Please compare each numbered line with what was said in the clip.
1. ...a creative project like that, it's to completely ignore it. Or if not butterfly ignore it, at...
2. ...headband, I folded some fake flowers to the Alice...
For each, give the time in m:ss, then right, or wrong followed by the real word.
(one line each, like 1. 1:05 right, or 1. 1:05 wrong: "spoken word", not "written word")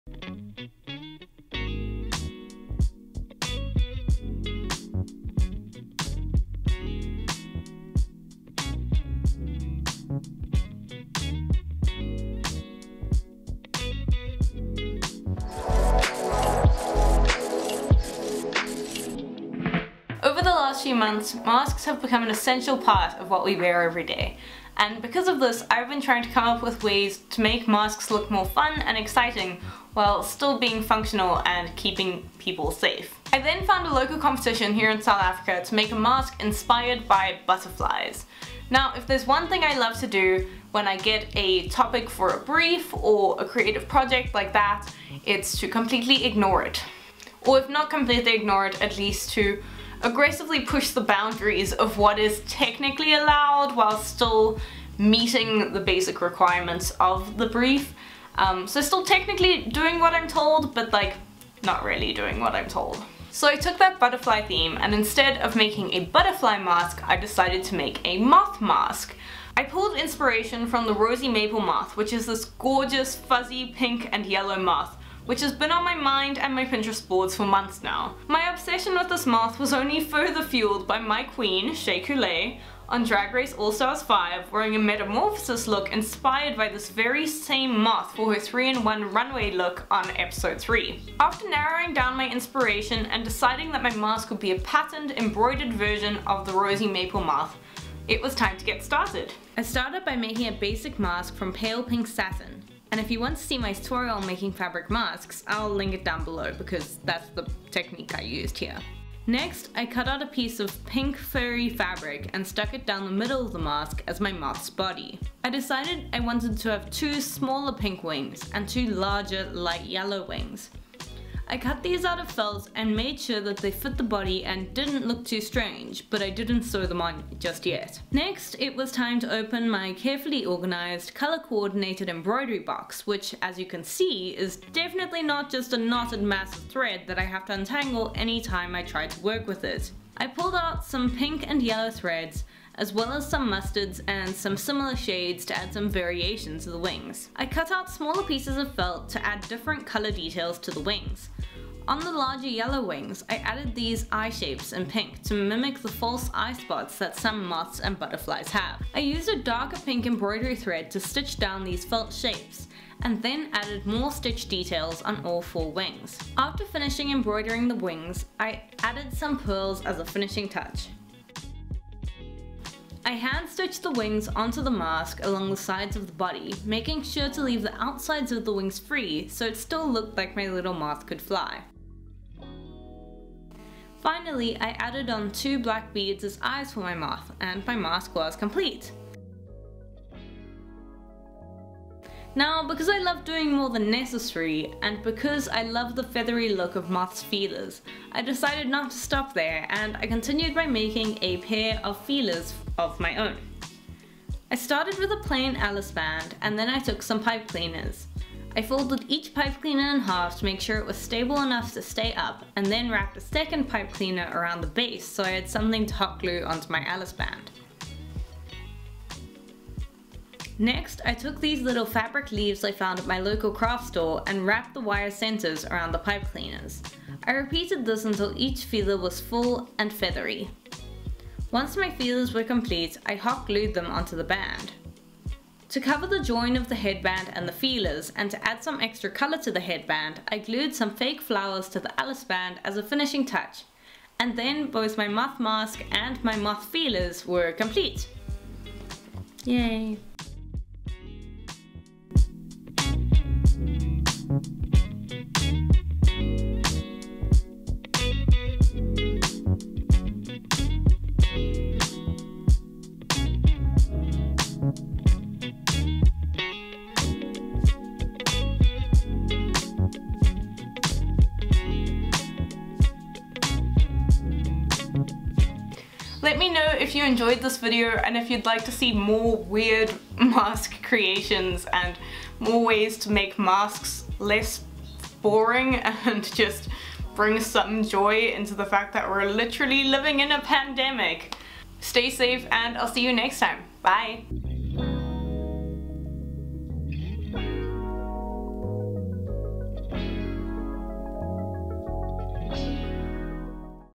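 1. 0:43 wrong: "completely", not "butterfly"
2. 3:59 wrong: "glued", not "folded".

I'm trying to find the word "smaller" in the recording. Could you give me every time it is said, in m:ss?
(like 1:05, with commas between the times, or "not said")
1:57, 2:27.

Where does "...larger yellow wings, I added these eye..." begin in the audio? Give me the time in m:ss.
2:32.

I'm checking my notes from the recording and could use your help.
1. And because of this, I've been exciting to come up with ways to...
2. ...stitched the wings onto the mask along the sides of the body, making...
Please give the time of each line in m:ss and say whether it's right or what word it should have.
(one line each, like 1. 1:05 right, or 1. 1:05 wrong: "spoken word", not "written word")
1. 0:24 wrong: "trying", not "exciting"
2. 2:53 right.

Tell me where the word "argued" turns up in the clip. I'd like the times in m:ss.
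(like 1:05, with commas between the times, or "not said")
not said.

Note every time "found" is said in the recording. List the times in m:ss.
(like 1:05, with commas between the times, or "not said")
0:33, 3:42.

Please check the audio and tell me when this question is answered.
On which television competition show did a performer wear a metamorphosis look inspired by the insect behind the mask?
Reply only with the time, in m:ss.
1:23.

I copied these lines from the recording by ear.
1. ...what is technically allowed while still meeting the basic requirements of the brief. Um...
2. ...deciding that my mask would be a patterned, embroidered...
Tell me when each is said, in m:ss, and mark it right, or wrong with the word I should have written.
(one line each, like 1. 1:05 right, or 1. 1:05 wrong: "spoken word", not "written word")
1. 0:51 right
2. 1:33 right.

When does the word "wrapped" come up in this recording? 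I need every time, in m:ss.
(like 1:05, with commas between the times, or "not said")
3:32, 3:44.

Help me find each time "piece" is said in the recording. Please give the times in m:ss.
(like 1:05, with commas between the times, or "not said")
1:50, 2:28.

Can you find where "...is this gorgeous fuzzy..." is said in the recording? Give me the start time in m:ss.
1:12.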